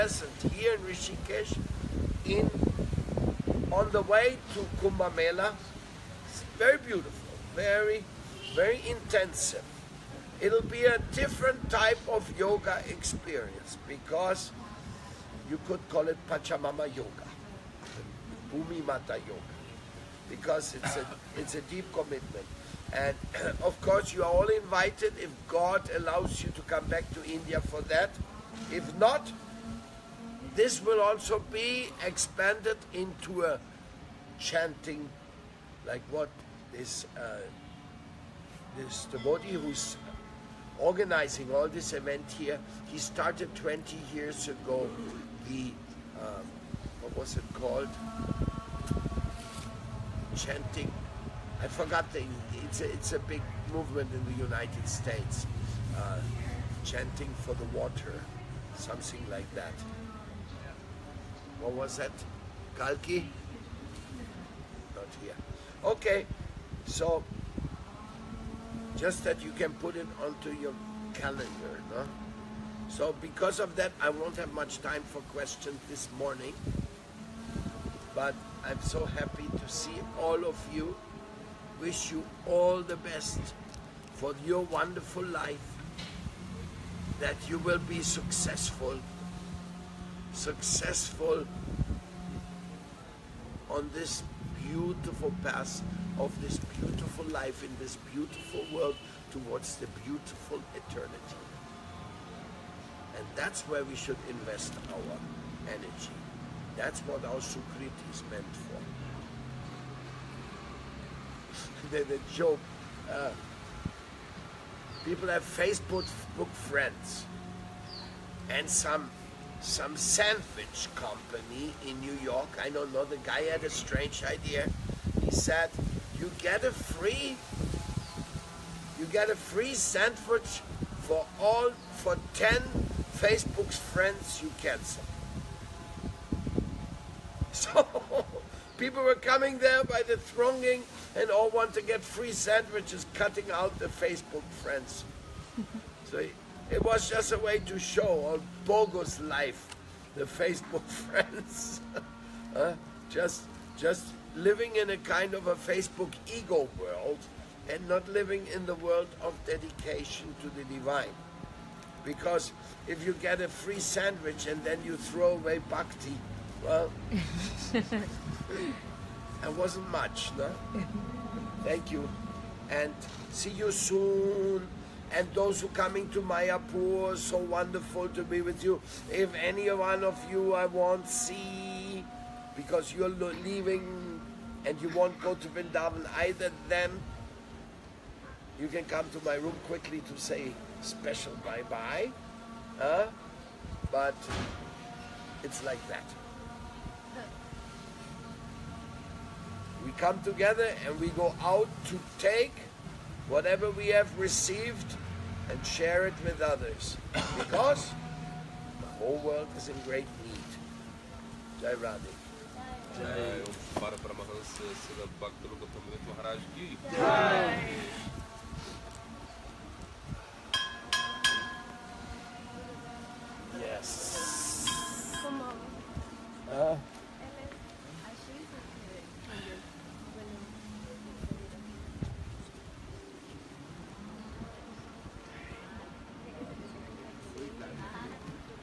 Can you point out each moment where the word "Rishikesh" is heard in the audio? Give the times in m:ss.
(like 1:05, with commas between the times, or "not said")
0:00.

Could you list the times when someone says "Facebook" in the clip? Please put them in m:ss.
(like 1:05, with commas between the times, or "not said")
1:55, 2:13, 2:23, 2:30, 2:35.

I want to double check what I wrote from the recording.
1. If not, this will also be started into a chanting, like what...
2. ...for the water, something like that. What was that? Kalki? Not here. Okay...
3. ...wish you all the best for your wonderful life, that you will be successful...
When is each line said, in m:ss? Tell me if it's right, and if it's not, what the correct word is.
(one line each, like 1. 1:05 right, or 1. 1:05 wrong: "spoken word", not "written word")
1. 0:28 wrong: "expanded", not "started"
2. 0:57 right
3. 1:21 right.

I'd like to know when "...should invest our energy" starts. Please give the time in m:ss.
1:43.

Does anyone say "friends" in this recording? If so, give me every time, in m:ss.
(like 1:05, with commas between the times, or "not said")
1:56, 2:13, 2:24, 2:30.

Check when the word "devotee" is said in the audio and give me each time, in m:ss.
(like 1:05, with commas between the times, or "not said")
0:39.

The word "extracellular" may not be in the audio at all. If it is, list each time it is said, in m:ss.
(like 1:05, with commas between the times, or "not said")
not said.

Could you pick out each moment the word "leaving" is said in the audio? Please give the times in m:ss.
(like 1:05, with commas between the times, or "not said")
3:03.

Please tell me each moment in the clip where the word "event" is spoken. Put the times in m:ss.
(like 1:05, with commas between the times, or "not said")
0:41.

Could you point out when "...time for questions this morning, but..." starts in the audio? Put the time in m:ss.
1:14.